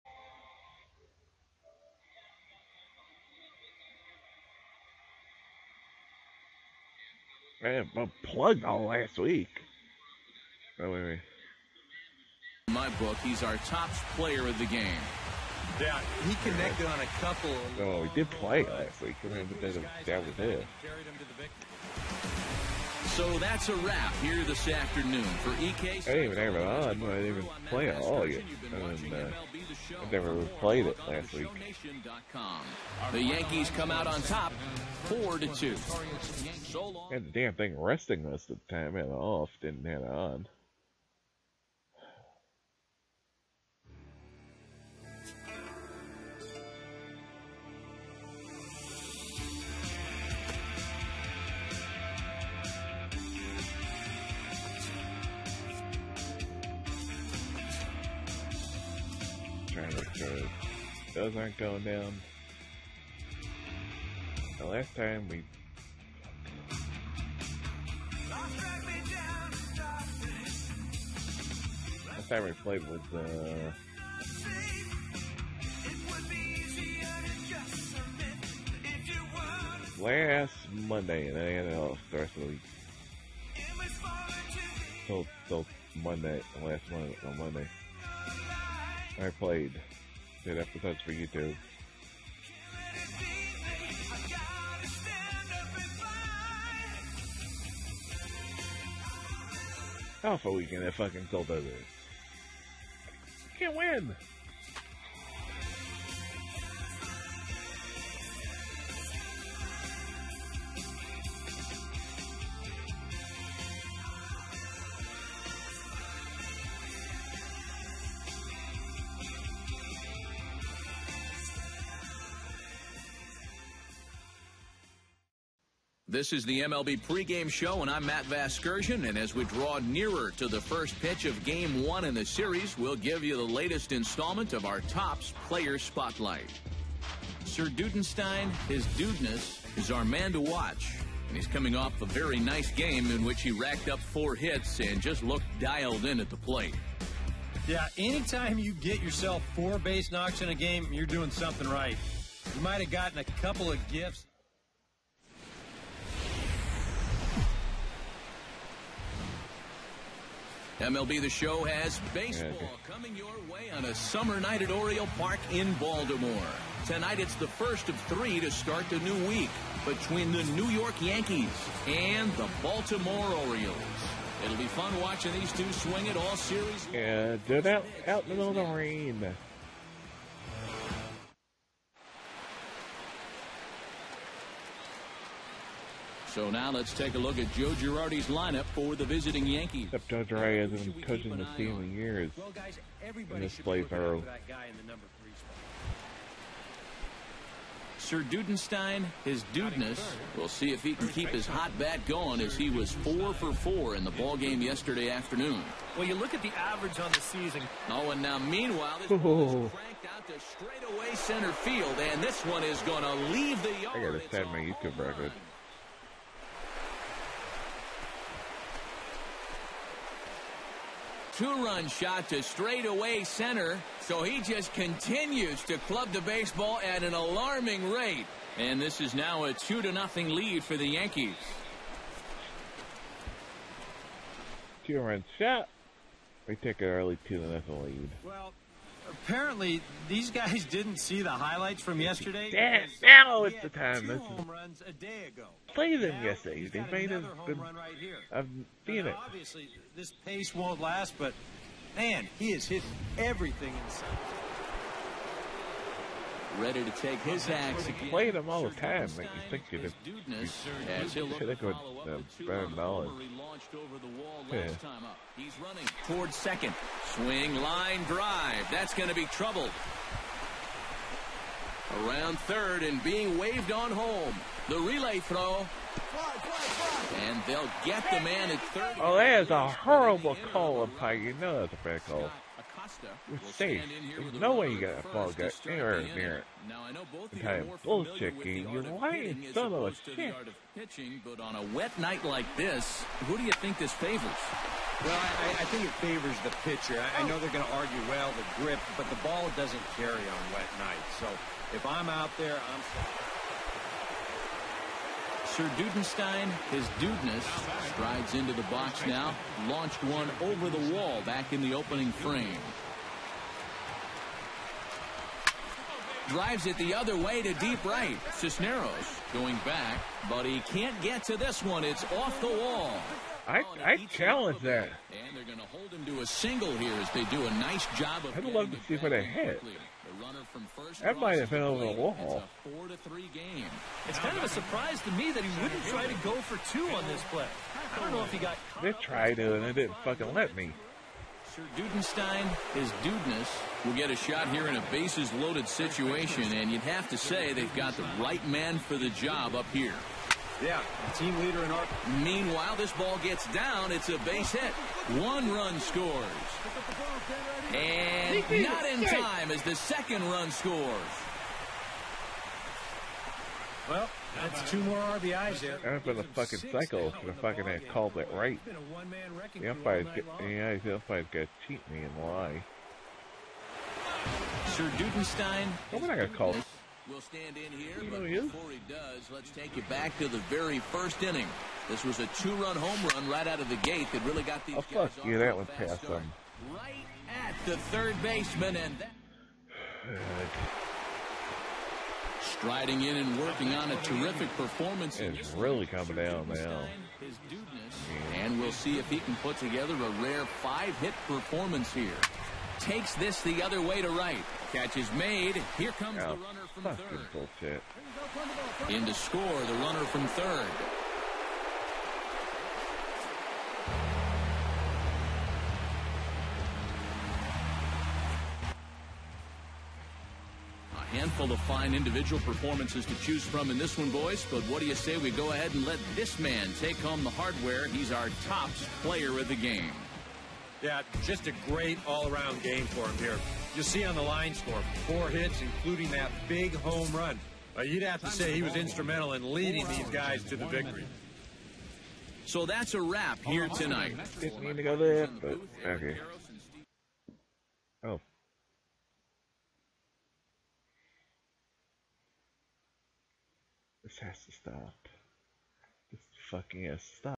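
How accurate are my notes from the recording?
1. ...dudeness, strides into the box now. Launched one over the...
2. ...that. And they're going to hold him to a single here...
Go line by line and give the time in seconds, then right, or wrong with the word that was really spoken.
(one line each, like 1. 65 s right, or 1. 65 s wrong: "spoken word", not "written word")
1. 306 s right
2. 324 s right.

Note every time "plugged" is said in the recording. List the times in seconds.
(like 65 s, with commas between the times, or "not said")
8 s.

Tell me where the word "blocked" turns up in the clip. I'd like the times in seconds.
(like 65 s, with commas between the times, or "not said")
not said.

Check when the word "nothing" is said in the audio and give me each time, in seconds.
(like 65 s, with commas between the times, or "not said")
229 s, 237 s.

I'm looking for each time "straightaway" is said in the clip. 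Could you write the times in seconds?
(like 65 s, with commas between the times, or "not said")
210 s, 222 s.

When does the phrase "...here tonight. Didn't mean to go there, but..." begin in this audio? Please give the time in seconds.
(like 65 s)
443 s.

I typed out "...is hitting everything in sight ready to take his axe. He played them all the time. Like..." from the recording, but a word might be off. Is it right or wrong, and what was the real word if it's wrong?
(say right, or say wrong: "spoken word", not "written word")
right.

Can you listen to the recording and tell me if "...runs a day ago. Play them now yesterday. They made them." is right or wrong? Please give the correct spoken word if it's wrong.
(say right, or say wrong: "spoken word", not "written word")
right.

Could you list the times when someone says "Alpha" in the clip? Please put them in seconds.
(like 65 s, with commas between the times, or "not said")
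100 s.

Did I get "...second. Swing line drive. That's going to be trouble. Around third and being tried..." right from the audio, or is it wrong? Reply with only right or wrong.
wrong.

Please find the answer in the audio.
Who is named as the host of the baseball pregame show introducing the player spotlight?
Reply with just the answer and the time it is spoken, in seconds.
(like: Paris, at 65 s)
Matt Vasgersian, at 128 s.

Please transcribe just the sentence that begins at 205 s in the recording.
Well, you look at the average on the season.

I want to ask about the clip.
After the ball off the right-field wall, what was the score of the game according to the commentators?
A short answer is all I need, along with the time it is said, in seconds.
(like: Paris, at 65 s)
4 to 3, at 332 s.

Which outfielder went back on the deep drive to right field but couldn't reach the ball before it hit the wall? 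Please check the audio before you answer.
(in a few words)
Cisneros.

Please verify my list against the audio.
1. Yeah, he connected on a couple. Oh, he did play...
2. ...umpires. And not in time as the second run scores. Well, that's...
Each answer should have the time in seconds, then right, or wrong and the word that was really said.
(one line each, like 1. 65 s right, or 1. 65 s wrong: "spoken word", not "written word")
1. 15 s right
2. 355 s wrong: "scores", not "umpires".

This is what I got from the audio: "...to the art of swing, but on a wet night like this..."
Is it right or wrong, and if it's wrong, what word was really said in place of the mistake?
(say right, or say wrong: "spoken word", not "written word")
wrong: "pitching", not "swing".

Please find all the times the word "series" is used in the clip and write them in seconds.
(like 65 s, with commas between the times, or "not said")
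132 s, 176 s.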